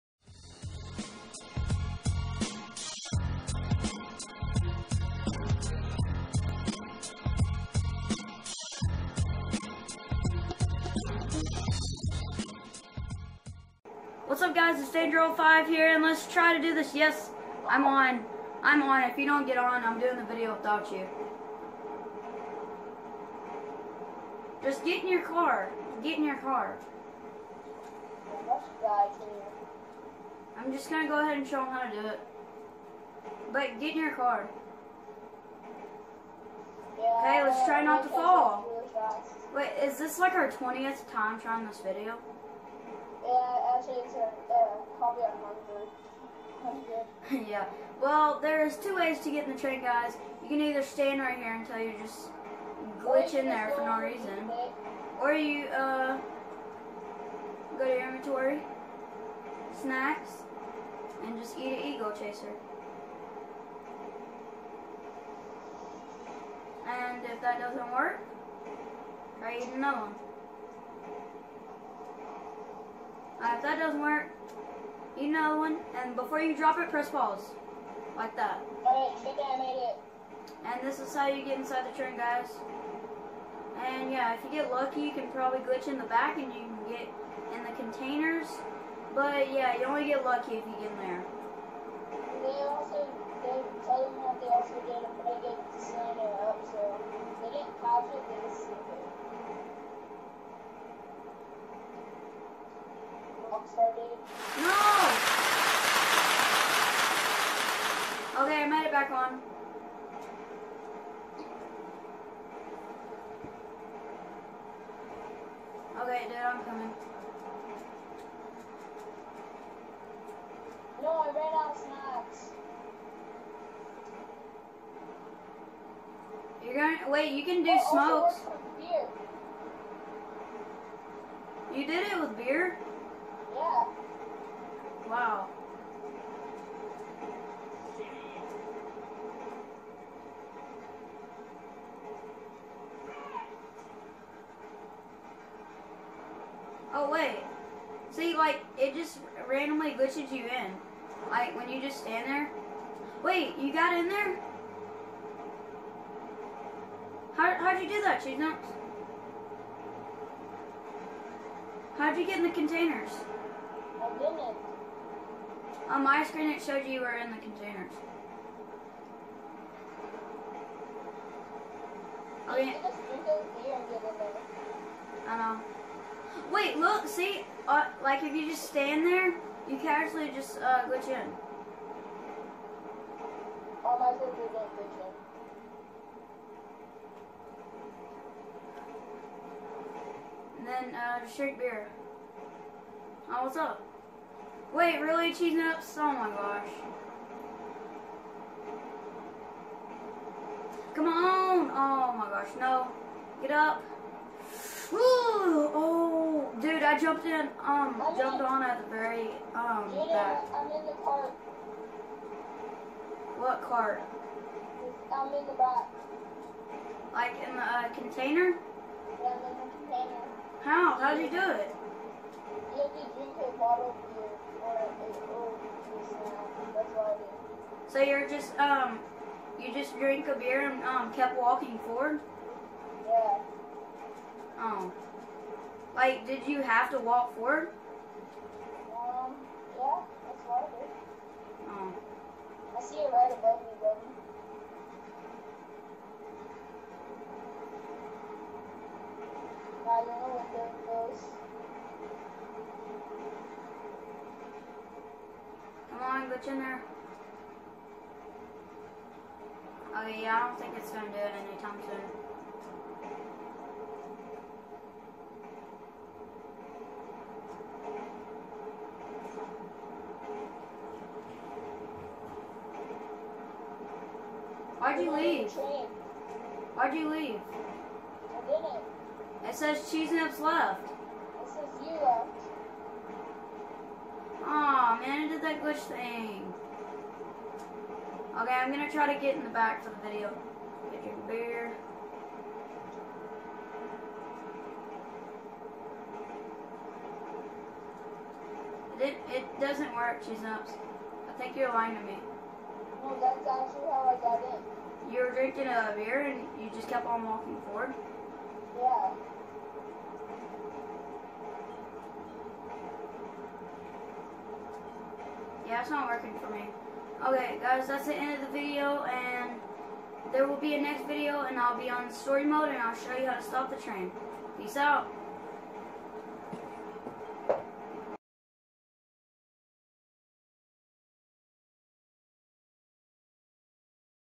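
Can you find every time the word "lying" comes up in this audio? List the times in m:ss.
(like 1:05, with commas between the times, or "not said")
5:01.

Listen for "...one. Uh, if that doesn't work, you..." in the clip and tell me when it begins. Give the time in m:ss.
1:10.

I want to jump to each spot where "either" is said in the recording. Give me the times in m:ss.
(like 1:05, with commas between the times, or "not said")
0:50.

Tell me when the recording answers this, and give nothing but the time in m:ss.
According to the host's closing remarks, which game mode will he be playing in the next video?
5:22.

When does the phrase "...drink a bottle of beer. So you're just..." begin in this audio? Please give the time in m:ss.
3:43.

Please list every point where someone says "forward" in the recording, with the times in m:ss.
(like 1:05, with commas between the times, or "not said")
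3:51, 3:57, 5:07.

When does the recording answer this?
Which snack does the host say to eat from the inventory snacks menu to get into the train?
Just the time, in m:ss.
1:02.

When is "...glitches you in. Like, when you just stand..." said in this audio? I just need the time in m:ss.
2:29.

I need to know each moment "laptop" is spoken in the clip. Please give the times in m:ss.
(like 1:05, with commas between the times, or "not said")
not said.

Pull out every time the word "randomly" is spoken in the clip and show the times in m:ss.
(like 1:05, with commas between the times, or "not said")
2:29.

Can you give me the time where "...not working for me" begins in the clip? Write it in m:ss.
5:15.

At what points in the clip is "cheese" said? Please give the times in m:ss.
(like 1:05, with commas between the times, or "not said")
2:38, 3:15, 4:39, 5:00.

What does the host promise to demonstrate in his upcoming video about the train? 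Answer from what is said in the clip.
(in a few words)
how to stop the train.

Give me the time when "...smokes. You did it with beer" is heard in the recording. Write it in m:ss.
2:08.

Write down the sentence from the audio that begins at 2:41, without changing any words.
How'd you get in the containers?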